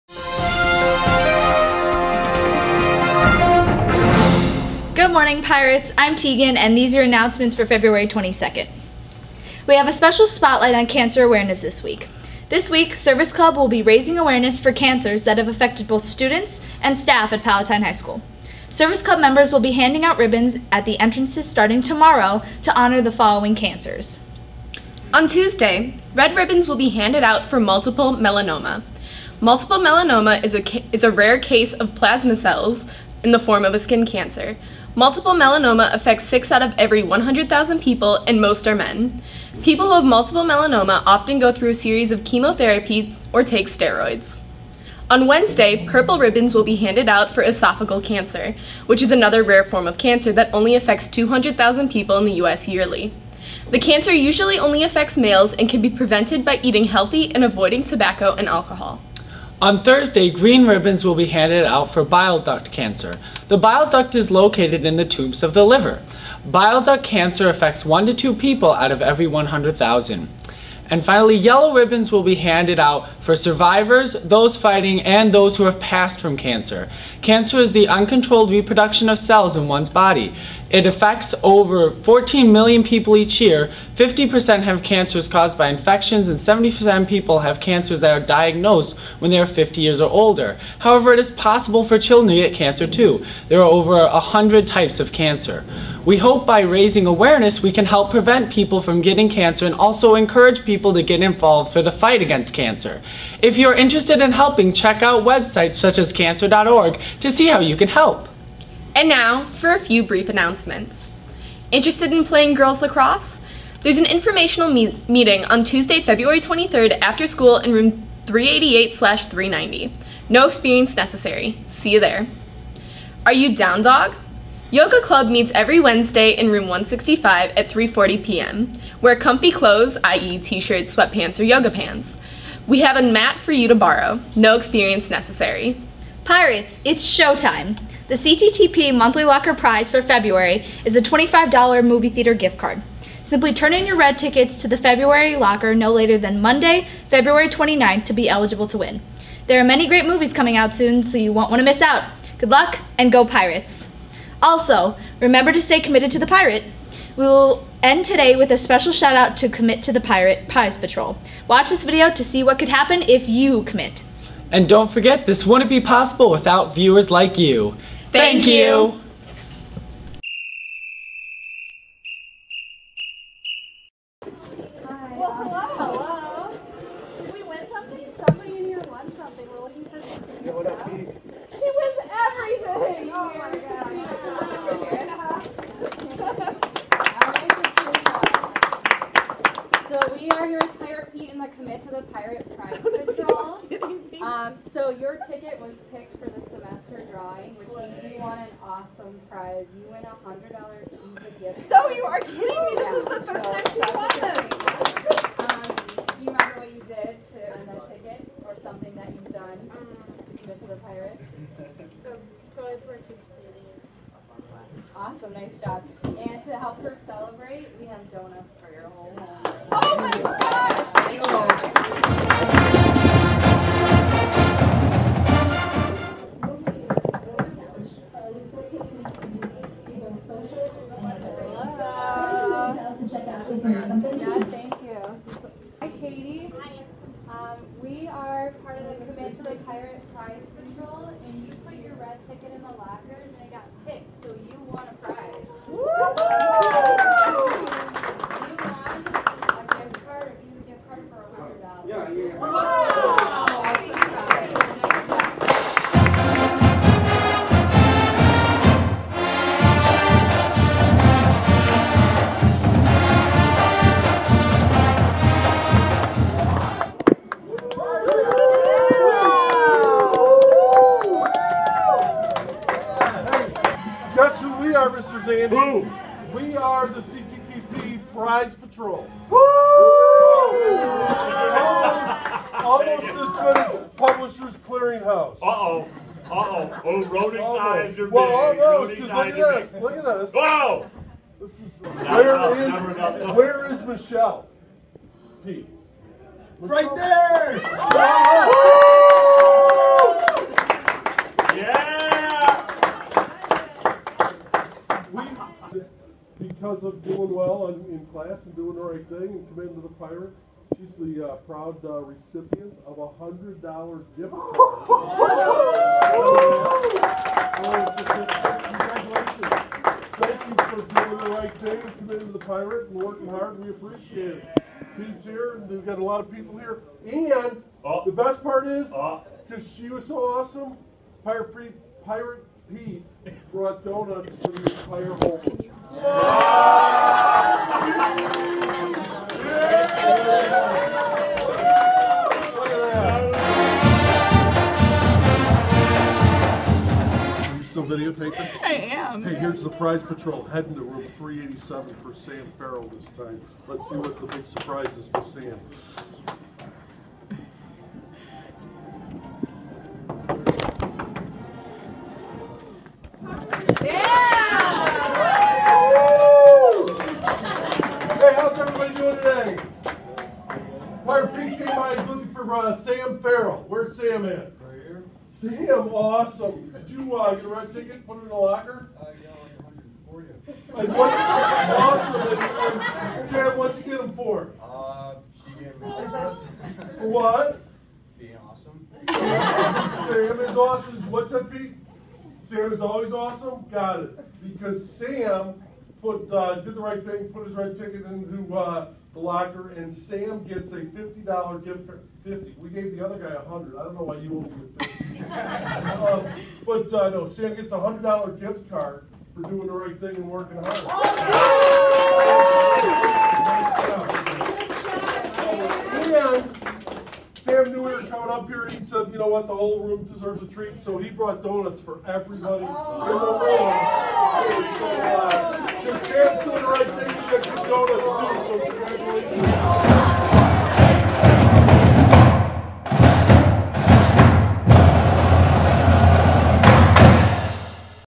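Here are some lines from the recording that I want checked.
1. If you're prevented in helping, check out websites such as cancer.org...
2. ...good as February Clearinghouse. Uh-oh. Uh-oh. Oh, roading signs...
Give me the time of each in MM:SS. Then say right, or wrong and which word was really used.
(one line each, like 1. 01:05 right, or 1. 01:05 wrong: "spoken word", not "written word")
1. 01:43 wrong: "interested", not "prevented"
2. 04:43 wrong: "Publishers", not "February".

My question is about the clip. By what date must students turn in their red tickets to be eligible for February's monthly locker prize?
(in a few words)
February 29th.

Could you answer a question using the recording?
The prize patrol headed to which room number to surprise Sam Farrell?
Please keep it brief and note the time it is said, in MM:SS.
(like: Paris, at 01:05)
387, at 05:51.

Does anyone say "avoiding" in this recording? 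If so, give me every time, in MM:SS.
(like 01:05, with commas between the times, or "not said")
00:57.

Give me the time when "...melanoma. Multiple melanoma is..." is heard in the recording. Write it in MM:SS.
00:28.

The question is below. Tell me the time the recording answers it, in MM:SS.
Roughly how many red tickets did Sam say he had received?
06:22.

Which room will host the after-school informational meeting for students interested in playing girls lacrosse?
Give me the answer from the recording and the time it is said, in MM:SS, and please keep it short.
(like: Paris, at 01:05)
388/390, at 01:58.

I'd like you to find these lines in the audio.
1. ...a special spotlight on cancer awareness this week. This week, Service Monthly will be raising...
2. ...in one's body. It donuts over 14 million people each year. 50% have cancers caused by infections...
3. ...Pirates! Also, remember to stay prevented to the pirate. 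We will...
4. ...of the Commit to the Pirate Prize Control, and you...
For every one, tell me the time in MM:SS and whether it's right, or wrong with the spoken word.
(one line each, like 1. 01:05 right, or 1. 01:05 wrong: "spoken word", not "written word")
1. 00:09 wrong: "Club", not "Monthly"
2. 01:19 wrong: "affects", not "donuts"
3. 02:33 wrong: "committed", not "prevented"
4. 03:58 right.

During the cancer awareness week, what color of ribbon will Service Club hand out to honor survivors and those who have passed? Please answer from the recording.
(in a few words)
Yellow.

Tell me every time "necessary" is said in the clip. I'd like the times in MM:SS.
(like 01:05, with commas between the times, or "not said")
02:00, 02:15.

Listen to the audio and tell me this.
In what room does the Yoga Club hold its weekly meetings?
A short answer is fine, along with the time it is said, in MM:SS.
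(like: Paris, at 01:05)
165, at 02:06.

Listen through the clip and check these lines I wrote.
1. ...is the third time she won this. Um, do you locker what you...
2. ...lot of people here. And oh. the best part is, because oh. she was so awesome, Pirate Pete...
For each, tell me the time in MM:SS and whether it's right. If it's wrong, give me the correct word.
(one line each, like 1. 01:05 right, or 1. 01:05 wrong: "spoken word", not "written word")
1. 03:22 wrong: "remember", not "locker"
2. 05:26 right.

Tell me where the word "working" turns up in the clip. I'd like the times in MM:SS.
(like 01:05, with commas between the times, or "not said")
05:22, 06:50.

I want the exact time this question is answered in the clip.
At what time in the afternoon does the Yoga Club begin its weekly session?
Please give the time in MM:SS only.
02:07.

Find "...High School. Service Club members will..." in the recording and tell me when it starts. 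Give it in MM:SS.
00:17.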